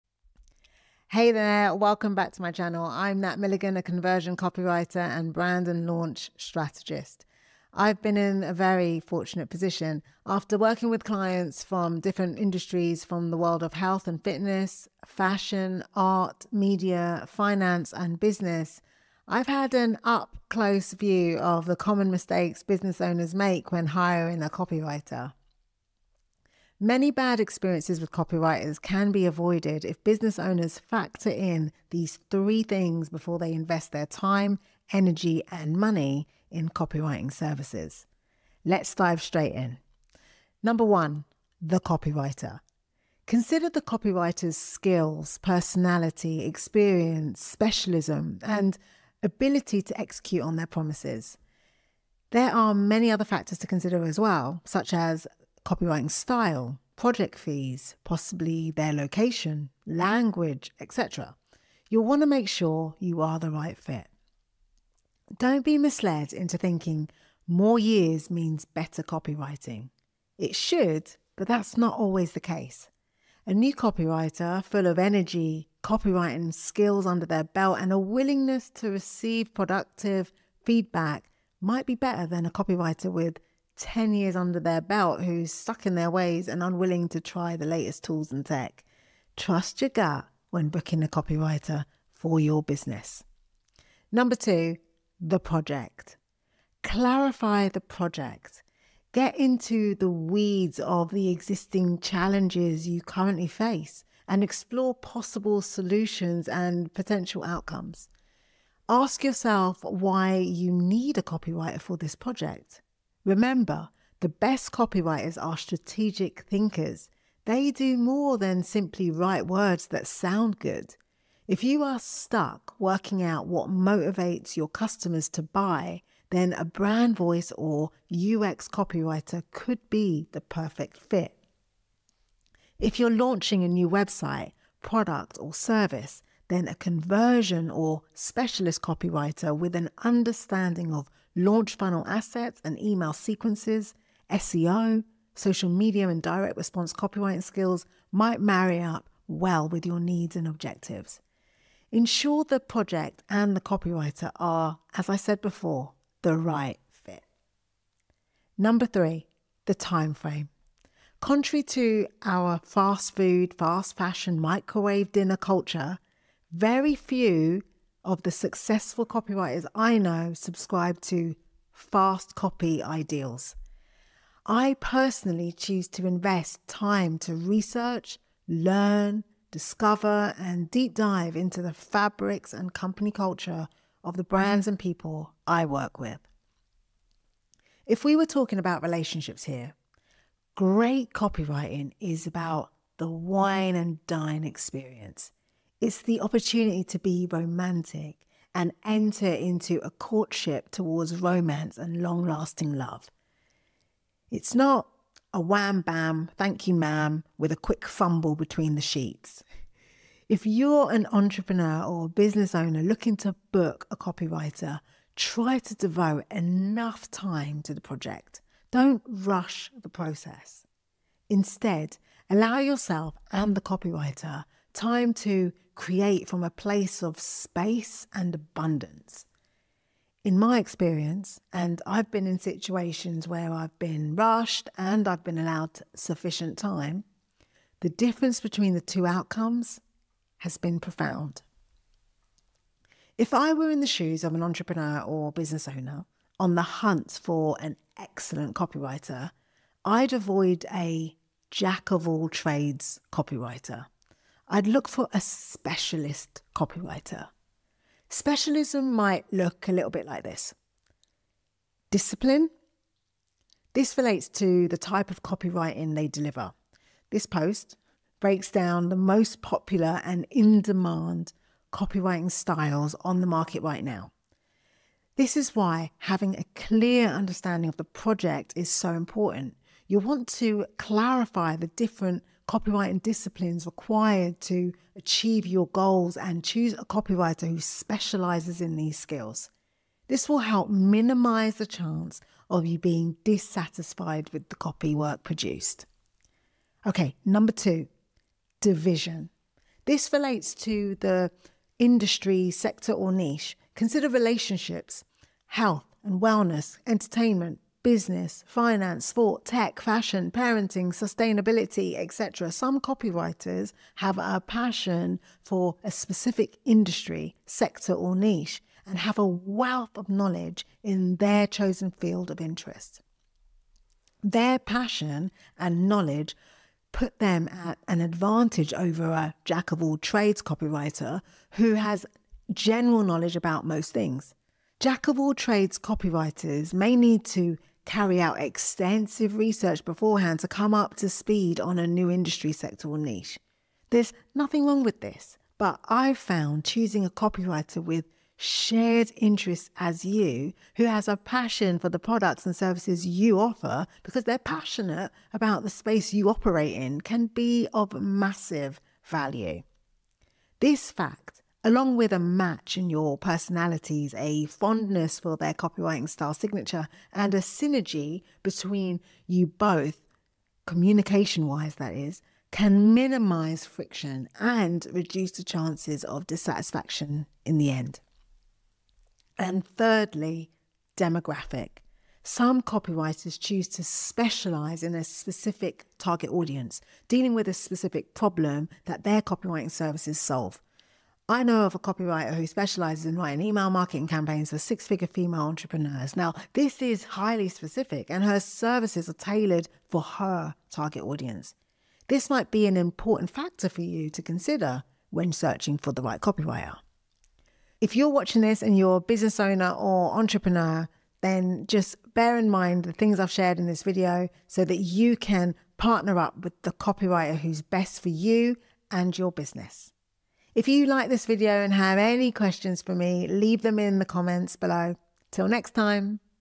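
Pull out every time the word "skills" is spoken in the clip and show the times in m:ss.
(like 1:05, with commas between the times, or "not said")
0:44, 1:16, 2:27, 4:48.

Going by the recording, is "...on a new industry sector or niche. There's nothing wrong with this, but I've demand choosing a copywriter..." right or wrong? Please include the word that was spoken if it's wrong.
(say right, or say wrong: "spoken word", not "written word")
wrong: "found", not "demand".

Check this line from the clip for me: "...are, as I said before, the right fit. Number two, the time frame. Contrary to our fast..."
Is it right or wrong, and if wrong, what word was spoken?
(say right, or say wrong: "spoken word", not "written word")
wrong: "three", not "two".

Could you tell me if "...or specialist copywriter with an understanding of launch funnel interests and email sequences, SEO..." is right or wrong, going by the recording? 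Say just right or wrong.
wrong.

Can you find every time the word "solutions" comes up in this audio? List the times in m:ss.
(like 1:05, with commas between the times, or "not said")
1:45.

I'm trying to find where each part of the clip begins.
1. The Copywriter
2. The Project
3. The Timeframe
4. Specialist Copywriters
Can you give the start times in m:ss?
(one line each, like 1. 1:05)
1. 0:41
2. 1:34
3. 2:39
4. 4:10.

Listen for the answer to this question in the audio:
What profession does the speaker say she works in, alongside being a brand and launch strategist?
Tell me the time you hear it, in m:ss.
0:03.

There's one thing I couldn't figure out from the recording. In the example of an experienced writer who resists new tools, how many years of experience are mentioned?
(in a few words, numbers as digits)
10.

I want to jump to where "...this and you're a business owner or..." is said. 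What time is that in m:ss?
6:48.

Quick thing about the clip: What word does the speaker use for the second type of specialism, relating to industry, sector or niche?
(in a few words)
Division.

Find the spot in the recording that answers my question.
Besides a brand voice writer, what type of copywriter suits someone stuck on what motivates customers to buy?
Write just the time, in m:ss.
2:08.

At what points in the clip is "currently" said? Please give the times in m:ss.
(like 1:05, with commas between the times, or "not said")
1:43.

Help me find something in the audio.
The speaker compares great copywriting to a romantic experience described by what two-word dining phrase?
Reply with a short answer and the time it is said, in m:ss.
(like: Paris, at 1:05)
Wine and dine, at 3:13.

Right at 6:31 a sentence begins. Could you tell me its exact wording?
I know of a copywriter who specializes in writing email marketing campaigns for six figure female entrepreneurs.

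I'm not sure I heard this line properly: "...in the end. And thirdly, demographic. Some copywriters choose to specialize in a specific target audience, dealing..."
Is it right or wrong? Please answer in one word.
right.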